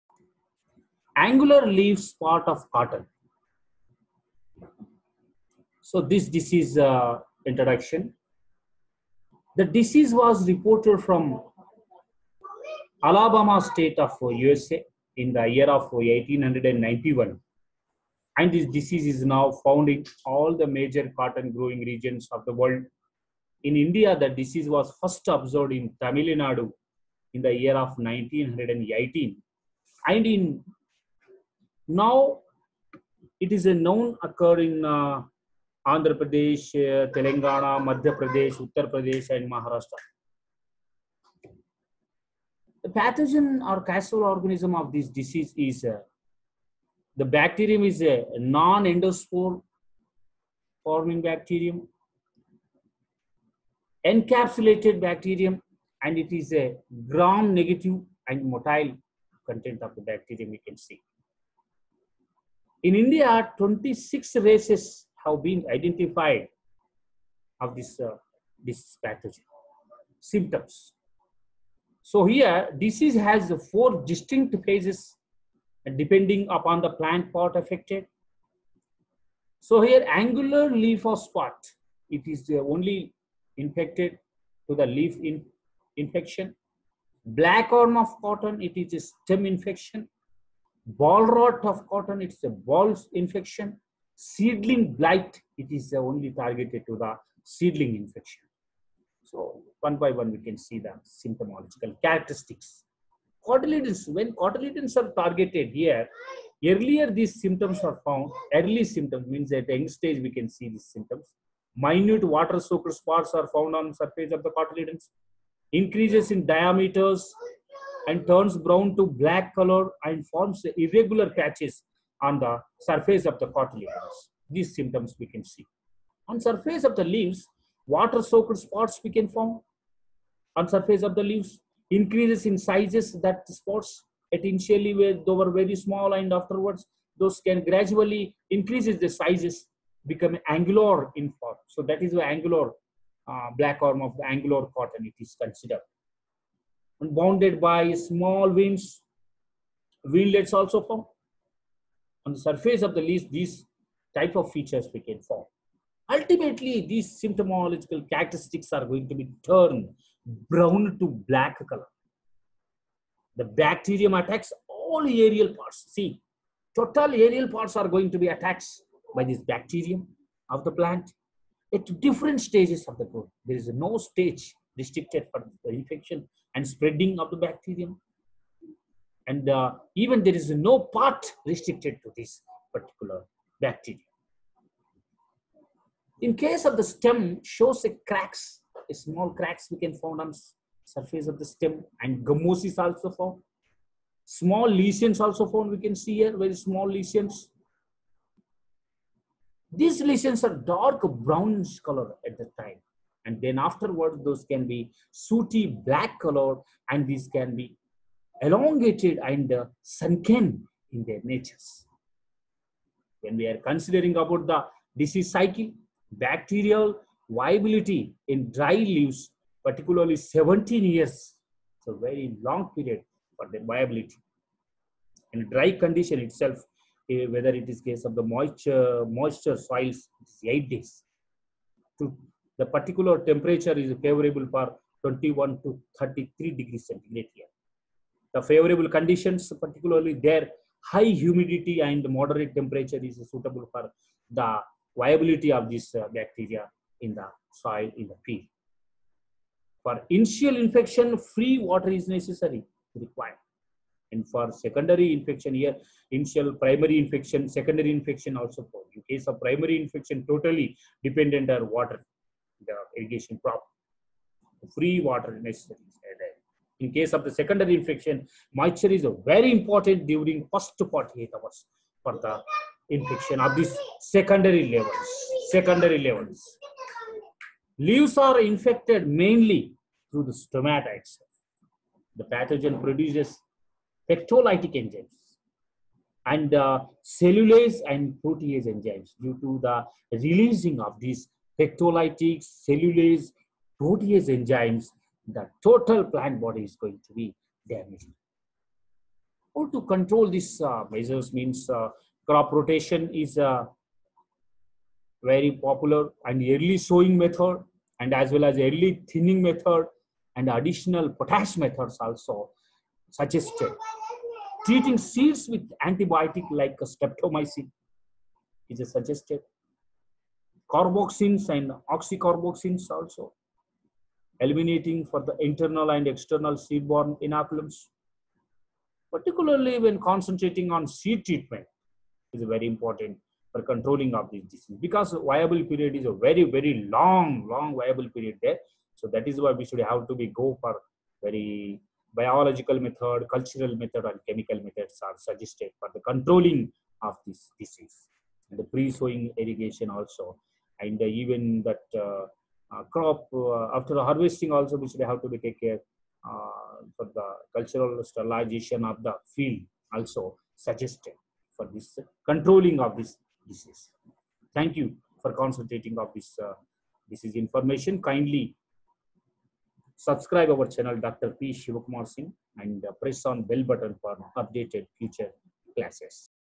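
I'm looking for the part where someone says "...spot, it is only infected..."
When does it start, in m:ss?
1:21.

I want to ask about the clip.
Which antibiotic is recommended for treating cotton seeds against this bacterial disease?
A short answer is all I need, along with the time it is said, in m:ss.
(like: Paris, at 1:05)
streptomycin, at 5:16.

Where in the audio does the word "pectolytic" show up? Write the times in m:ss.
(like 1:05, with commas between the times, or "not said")
4:44, 4:51.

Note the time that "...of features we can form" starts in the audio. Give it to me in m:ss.
2:34.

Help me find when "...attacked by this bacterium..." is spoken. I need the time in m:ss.
2:48.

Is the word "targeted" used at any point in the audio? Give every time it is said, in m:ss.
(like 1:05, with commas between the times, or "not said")
1:36, 1:45.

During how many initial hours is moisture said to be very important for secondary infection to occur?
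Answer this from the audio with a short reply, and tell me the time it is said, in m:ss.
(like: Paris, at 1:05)
48, at 4:30.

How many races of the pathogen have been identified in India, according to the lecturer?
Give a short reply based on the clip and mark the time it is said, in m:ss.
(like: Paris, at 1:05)
26, at 1:03.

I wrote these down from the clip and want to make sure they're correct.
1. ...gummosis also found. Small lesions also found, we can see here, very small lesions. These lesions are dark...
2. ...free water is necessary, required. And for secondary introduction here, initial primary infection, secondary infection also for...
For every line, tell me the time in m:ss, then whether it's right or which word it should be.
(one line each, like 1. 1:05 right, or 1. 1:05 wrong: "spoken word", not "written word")
1. 3:12 right
2. 4:11 wrong: "infection", not "introduction".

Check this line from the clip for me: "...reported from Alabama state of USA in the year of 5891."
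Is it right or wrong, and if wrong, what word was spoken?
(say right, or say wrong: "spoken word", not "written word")
wrong: "1891", not "5891".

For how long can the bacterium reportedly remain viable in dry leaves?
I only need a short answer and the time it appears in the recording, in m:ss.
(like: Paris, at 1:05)
17 years, at 3:40.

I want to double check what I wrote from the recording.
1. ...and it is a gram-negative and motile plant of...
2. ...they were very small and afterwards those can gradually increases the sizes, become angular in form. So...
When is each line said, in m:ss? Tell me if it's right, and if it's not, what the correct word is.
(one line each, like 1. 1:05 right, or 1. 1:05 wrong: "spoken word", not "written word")
1. 0:56 wrong: "content", not "plant"
2. 2:15 right.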